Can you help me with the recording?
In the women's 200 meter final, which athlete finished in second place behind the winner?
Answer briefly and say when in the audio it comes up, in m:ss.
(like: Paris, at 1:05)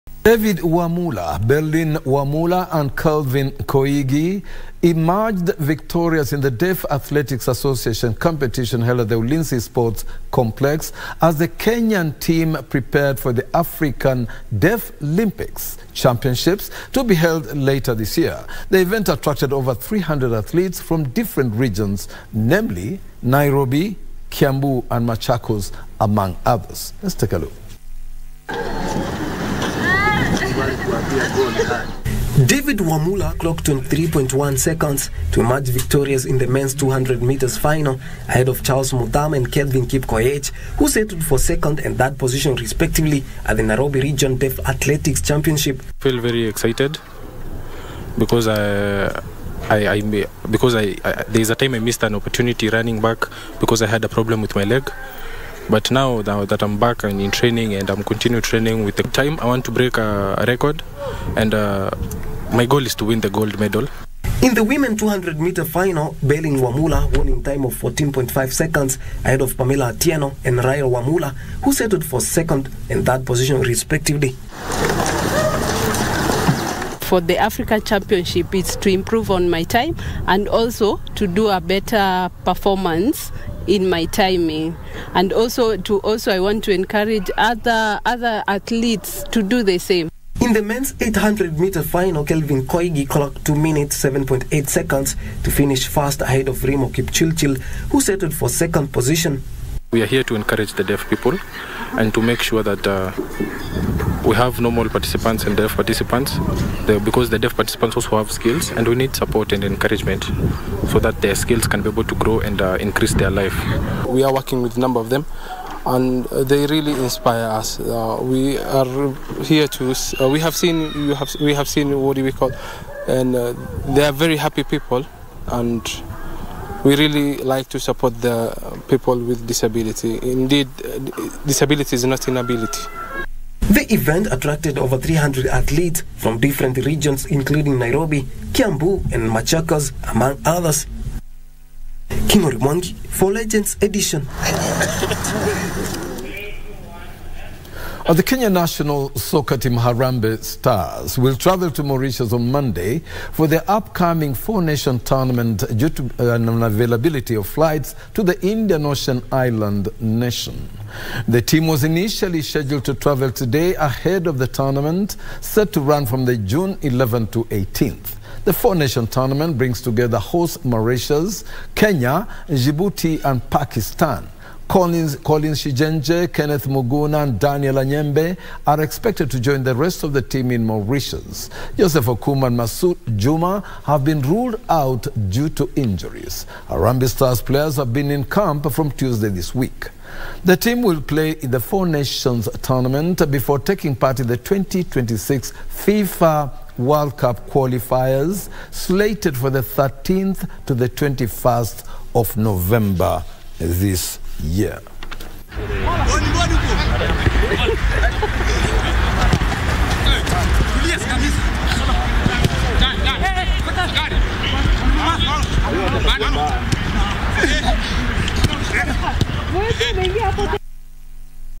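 Pamela Atieno, at 1:09.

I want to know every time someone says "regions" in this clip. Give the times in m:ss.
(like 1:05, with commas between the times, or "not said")
0:21, 0:43, 2:16.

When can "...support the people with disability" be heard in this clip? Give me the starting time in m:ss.
2:07.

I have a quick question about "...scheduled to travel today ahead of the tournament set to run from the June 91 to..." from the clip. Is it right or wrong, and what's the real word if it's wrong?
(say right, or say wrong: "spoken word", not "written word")
wrong: "11", not "91".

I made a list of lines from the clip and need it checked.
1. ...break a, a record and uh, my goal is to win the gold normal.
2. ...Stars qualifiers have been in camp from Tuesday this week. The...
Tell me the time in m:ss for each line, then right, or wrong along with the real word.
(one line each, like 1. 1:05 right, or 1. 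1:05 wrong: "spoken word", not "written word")
1. 0:59 wrong: "medal", not "normal"
2. 3:07 wrong: "players", not "qualifiers".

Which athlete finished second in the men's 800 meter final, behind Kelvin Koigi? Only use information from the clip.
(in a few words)
Remo Kipchilchil.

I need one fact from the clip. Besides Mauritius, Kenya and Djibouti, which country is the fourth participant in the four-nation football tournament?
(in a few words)
Pakistan.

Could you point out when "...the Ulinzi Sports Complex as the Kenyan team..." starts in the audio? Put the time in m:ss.
0:09.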